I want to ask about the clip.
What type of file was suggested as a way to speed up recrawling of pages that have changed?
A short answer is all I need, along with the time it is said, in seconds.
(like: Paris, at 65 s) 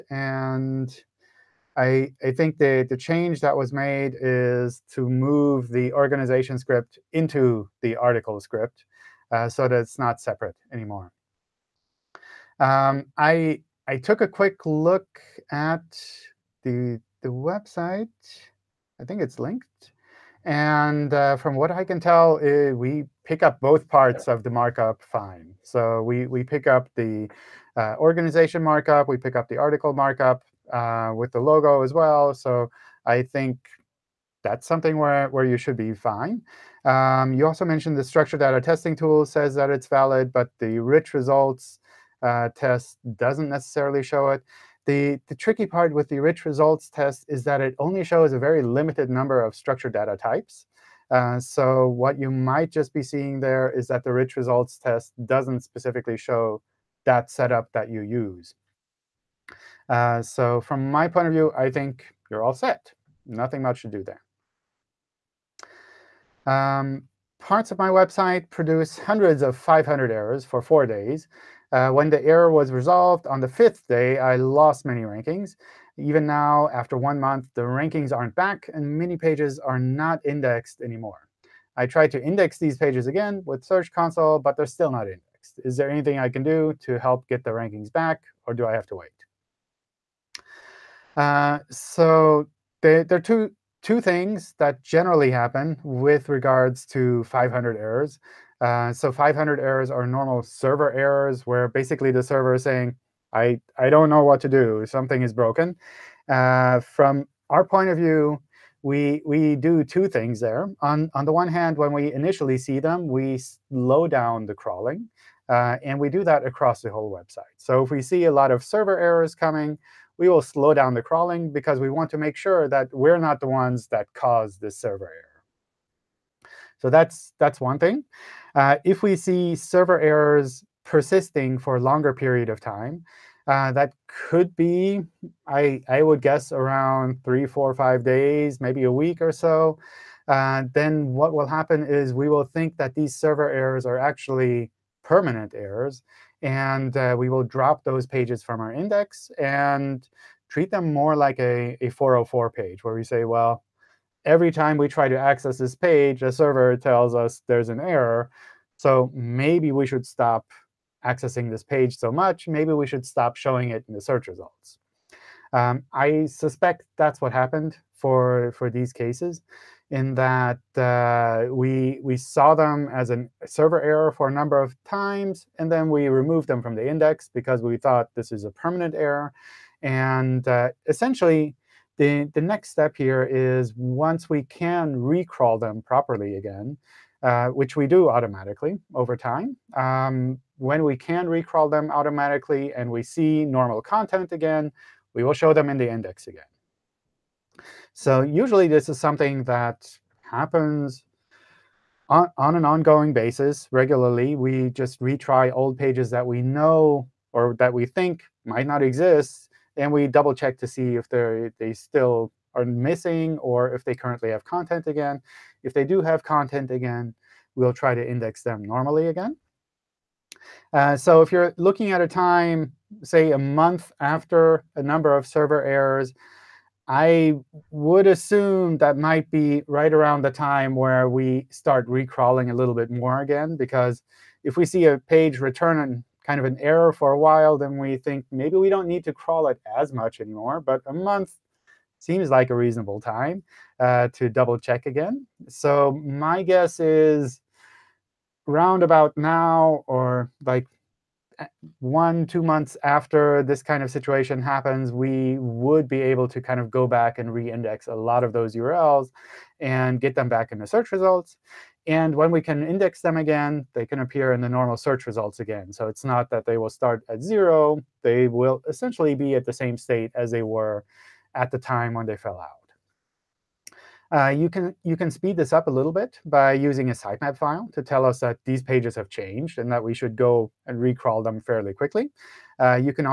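sitemap file, at 276 s.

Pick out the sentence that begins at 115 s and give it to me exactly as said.
Uh, and we do that across the whole website.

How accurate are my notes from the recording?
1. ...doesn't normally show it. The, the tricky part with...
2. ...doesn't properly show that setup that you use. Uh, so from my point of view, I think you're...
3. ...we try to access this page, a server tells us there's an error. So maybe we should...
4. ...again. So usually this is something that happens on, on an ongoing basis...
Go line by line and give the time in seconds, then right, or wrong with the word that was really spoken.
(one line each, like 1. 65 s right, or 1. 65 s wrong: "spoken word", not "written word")
1. 43 s wrong: "necessarily", not "normally"
2. 55 s wrong: "specifically", not "properly"
3. 154 s right
4. 196 s right.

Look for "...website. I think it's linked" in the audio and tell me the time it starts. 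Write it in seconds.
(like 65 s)
17 s.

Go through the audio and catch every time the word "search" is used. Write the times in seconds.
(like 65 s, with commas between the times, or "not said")
83 s, 164 s, 260 s, 264 s.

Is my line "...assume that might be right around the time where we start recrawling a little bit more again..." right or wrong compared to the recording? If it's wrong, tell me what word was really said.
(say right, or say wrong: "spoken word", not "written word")
right.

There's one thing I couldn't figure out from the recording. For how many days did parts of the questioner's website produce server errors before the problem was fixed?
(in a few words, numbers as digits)
4.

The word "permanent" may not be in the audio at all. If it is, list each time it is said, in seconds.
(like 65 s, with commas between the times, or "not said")
145 s, 178 s.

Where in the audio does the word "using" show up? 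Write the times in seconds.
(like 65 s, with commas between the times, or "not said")
276 s.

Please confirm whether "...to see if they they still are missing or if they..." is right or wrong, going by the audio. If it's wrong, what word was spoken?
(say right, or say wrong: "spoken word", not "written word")
right.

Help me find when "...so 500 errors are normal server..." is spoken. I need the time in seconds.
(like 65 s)
98 s.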